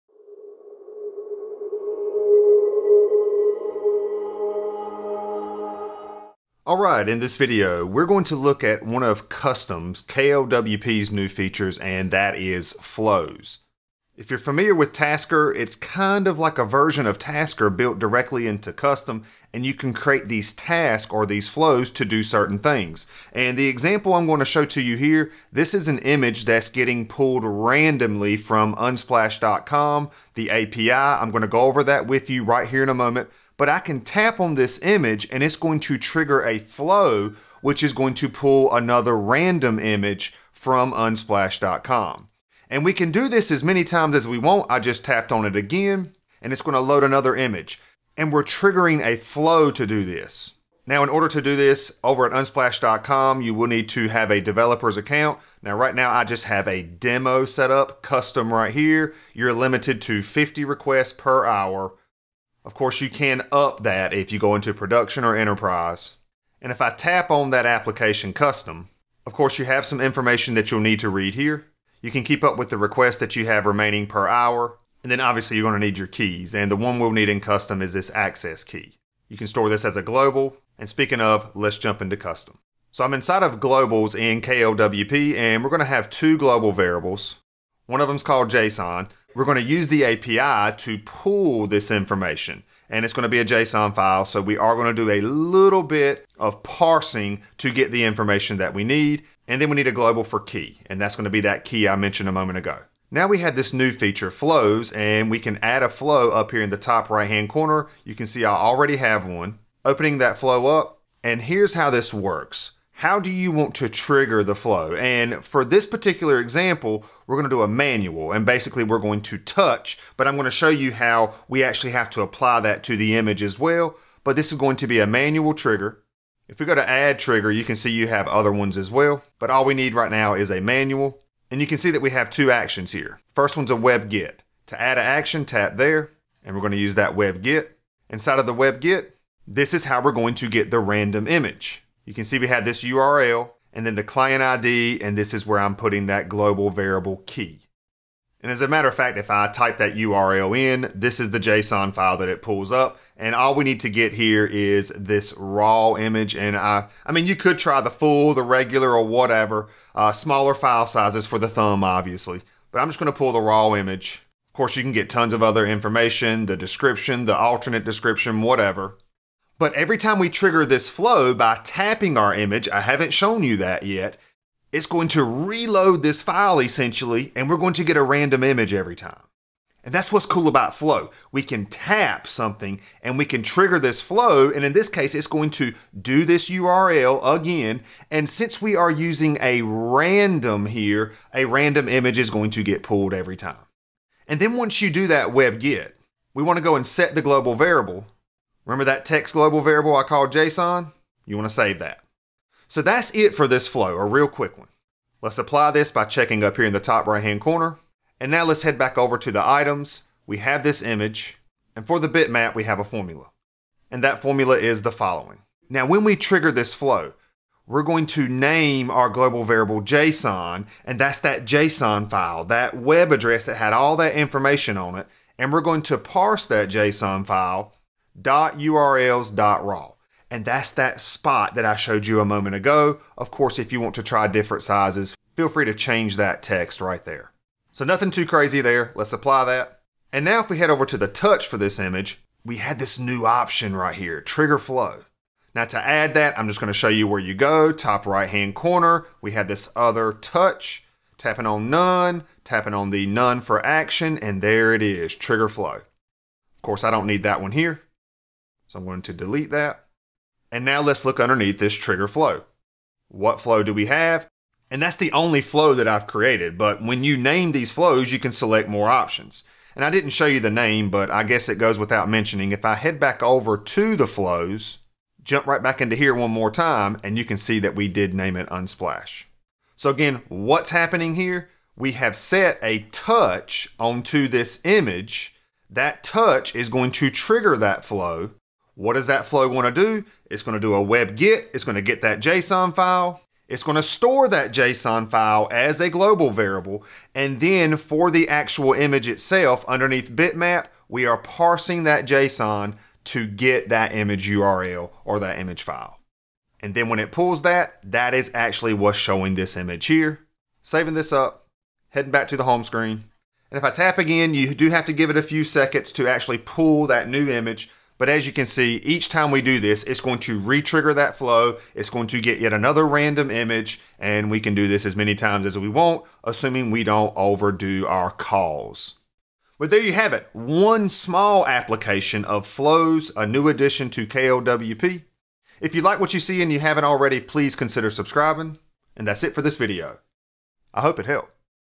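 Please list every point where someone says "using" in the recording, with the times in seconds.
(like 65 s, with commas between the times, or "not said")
188 s.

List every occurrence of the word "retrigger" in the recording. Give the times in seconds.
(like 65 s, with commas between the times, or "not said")
320 s.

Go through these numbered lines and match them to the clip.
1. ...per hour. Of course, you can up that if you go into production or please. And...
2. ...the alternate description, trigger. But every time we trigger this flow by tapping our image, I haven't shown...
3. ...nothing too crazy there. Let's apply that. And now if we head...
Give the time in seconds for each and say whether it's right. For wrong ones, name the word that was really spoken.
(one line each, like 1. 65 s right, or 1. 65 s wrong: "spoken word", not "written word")
1. 61 s wrong: "enterprise", not "please"
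2. 167 s wrong: "whatever", not "trigger"
3. 237 s right.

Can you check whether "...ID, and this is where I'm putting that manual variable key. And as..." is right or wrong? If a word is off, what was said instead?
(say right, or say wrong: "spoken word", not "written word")
wrong: "global", not "manual".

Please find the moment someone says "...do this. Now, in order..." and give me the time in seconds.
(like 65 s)
49 s.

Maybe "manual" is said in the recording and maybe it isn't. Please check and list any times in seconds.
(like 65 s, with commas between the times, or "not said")
117 s, 125 s, 130 s.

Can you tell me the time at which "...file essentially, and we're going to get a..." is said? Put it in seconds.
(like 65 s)
176 s.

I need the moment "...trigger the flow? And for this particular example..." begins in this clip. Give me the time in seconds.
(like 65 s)
113 s.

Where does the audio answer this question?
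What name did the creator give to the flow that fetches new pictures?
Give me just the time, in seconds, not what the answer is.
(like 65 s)
278 s.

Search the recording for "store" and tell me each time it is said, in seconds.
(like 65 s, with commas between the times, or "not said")
79 s, 293 s.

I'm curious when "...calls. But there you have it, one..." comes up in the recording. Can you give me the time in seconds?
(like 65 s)
328 s.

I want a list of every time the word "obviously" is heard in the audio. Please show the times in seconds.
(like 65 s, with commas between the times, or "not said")
75 s, 161 s.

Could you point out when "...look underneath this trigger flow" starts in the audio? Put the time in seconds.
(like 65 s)
261 s.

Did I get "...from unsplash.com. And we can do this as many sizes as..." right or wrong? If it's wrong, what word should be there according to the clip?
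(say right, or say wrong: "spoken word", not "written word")
wrong: "times", not "sizes".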